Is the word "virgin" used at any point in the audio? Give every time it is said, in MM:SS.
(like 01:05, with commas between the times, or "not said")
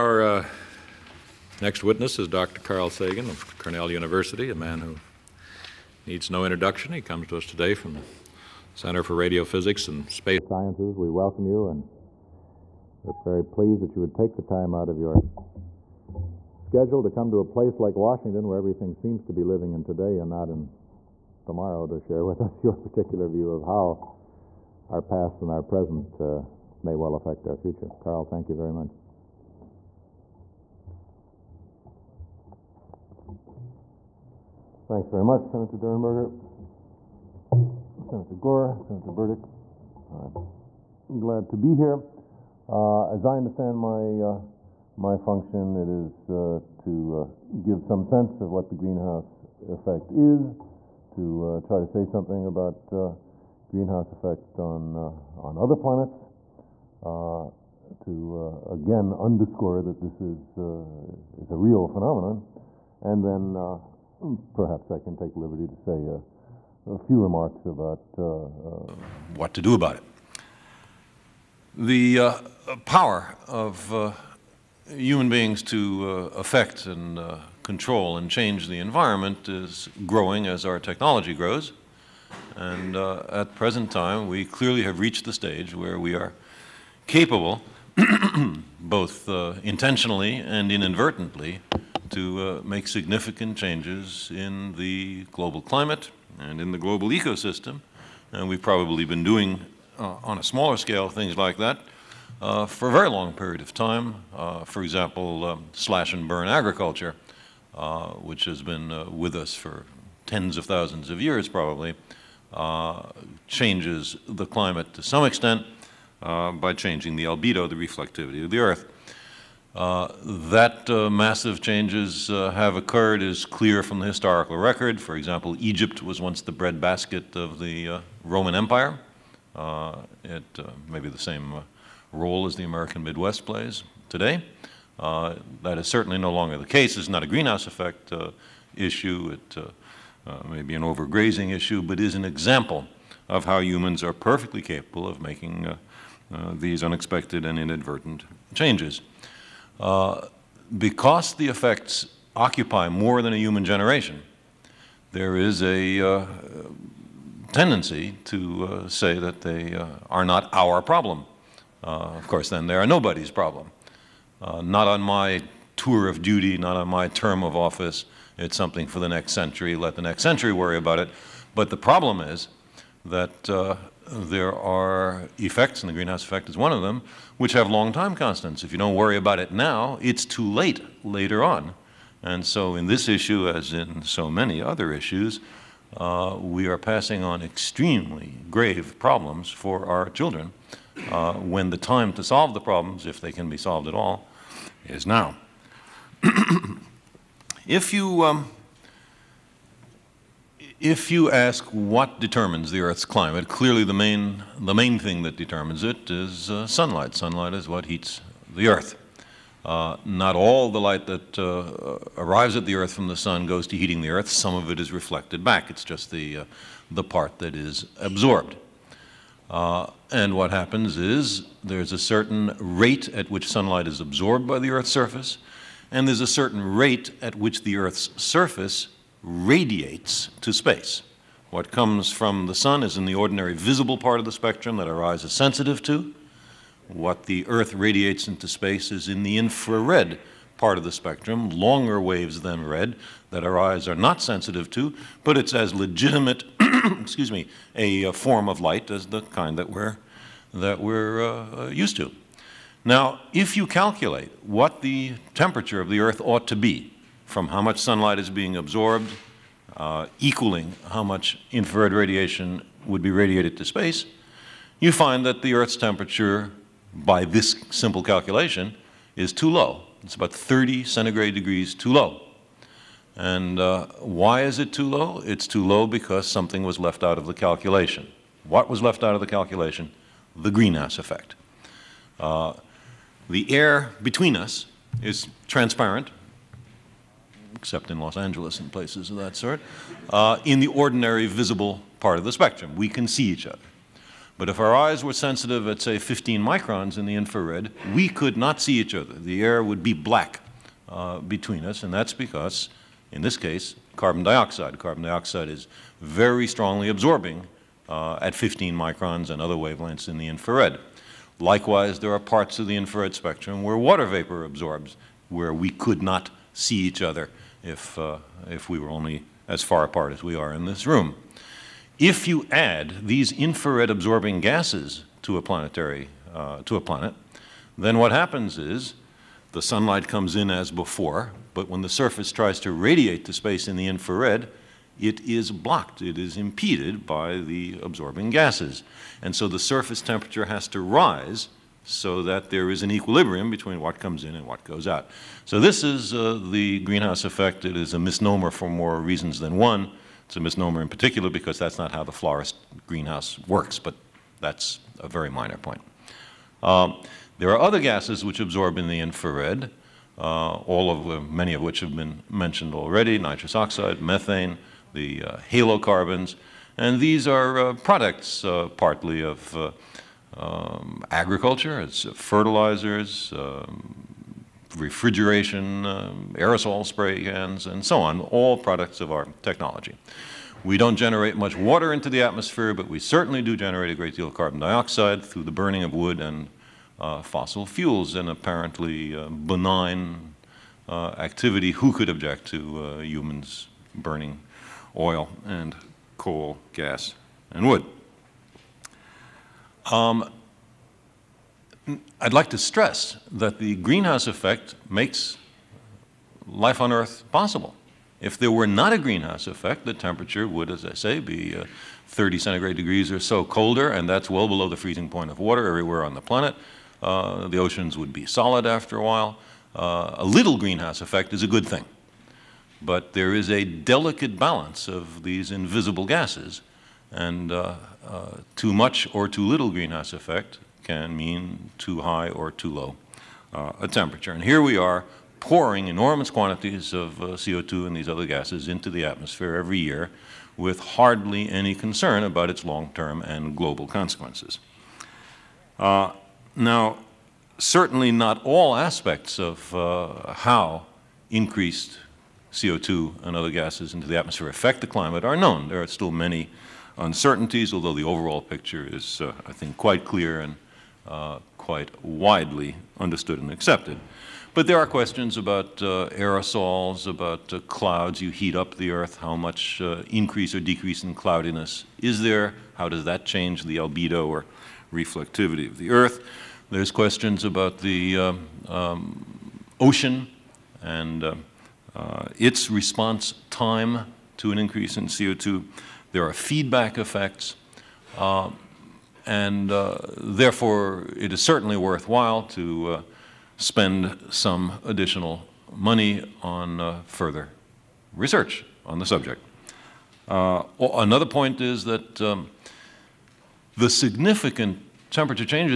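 not said.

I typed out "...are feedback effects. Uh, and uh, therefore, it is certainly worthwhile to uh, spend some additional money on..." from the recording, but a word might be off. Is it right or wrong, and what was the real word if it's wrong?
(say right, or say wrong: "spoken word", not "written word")
right.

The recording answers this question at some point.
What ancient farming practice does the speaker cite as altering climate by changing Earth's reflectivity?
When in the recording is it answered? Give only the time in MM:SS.
01:45.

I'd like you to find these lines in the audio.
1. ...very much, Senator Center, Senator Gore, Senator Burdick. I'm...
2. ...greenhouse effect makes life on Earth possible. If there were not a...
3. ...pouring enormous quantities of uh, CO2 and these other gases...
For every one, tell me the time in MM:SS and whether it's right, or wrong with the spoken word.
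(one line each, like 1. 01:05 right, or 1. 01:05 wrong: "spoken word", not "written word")
1. 00:35 wrong: "Durenberger", not "Center"
2. 06:43 right
3. 07:15 right.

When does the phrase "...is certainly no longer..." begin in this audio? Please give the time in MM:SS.
02:15.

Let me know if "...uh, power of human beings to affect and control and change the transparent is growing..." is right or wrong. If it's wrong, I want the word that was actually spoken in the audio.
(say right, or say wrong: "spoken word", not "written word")
wrong: "environment", not "transparent".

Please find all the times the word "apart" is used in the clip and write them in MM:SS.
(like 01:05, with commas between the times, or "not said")
05:19.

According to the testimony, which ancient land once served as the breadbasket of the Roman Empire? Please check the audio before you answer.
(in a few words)
Egypt.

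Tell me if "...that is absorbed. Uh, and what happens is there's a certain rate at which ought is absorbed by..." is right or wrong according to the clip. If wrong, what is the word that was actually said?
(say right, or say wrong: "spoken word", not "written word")
wrong: "sunlight", not "ought".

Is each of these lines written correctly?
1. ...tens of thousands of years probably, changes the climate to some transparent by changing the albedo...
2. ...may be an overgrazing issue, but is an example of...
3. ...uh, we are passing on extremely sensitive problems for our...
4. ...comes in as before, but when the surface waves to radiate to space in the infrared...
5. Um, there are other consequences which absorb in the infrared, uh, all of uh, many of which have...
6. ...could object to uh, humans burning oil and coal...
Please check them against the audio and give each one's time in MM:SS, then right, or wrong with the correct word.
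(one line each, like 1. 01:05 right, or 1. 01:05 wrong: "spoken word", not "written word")
1. 01:50 wrong: "extent", not "transparent"
2. 02:20 right
3. 03:05 wrong: "grave", not "sensitive"
4. 05:30 wrong: "tries", not "waves"
5. 05:56 wrong: "gases", not "consequences"
6. 06:31 right.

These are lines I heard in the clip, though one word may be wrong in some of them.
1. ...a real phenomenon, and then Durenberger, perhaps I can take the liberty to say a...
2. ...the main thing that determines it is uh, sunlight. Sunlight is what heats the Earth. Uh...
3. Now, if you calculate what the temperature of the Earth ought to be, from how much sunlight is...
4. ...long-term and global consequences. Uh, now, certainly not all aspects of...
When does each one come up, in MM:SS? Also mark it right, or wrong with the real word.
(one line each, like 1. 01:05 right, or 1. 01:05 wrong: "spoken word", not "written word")
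1. 01:01 wrong: "Hmm", not "Durenberger"
2. 03:24 right
3. 04:12 right
4. 07:22 right.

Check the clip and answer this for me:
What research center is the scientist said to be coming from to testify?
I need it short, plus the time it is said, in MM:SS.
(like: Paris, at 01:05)
Center for Radiophysics and Space Sciences, at 00:08.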